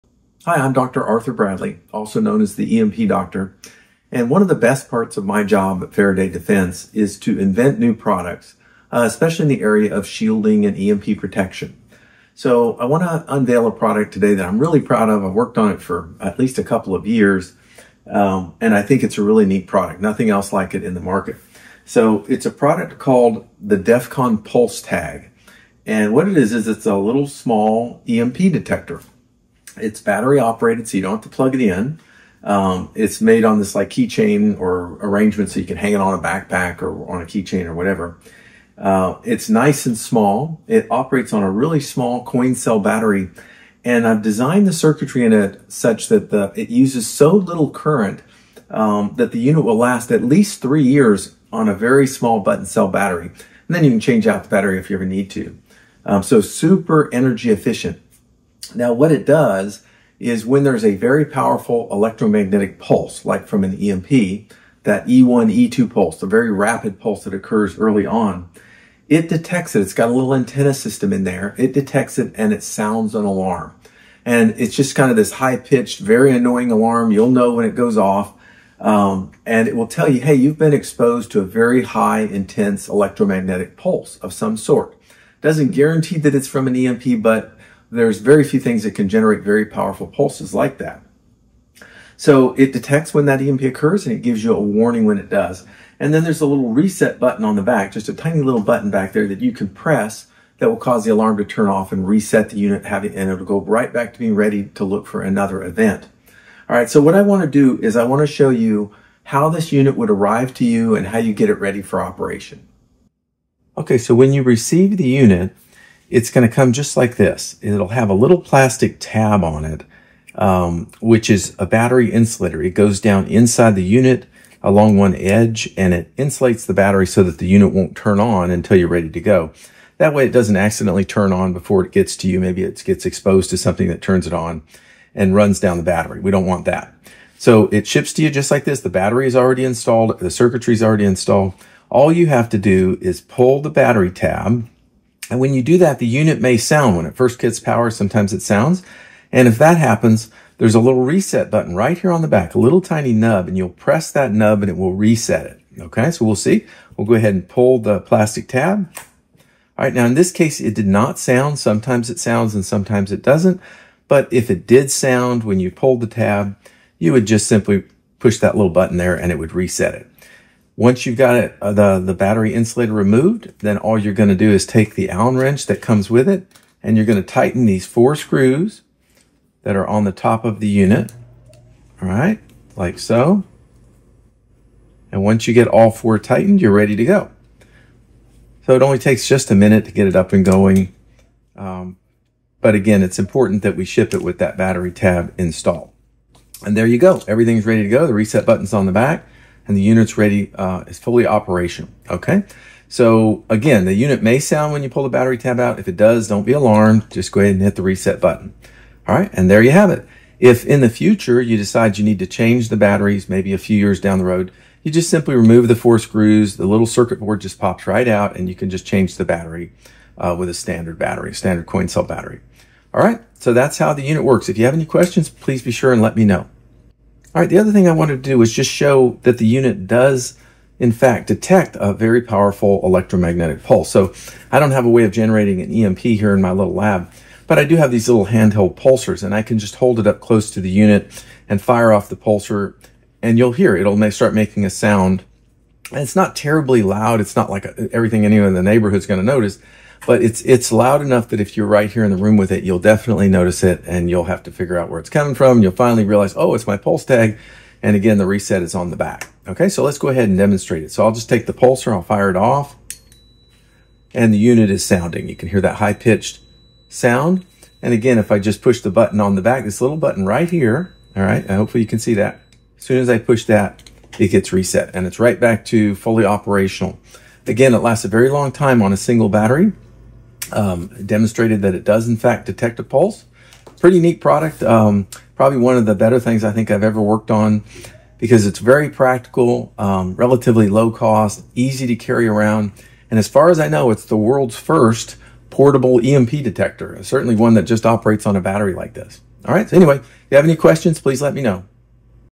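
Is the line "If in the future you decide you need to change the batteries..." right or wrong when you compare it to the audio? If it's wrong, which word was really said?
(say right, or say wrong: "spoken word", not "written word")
right.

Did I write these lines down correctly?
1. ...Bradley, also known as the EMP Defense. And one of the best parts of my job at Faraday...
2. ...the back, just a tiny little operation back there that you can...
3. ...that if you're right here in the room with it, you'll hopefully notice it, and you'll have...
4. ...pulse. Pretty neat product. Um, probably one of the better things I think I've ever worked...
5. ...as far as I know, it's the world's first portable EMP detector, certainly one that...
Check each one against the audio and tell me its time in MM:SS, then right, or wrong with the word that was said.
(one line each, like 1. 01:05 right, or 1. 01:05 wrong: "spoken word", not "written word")
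1. 00:01 wrong: "Doctor", not "Defense"
2. 01:37 wrong: "button", not "operation"
3. 04:11 wrong: "definitely", not "hopefully"
4. 04:42 right
5. 04:53 right.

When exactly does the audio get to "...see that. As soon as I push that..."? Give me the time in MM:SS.
04:31.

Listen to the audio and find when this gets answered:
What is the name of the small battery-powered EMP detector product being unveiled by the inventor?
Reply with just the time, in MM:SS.
00:23.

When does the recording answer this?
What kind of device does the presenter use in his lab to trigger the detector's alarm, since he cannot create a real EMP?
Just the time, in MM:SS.
03:58.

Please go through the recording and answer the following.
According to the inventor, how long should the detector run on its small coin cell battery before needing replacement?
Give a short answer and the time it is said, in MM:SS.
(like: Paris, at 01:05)
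3 years, at 00:50.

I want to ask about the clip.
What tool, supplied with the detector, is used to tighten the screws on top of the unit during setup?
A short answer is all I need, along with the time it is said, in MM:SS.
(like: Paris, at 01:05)
Allen wrench, at 02:55.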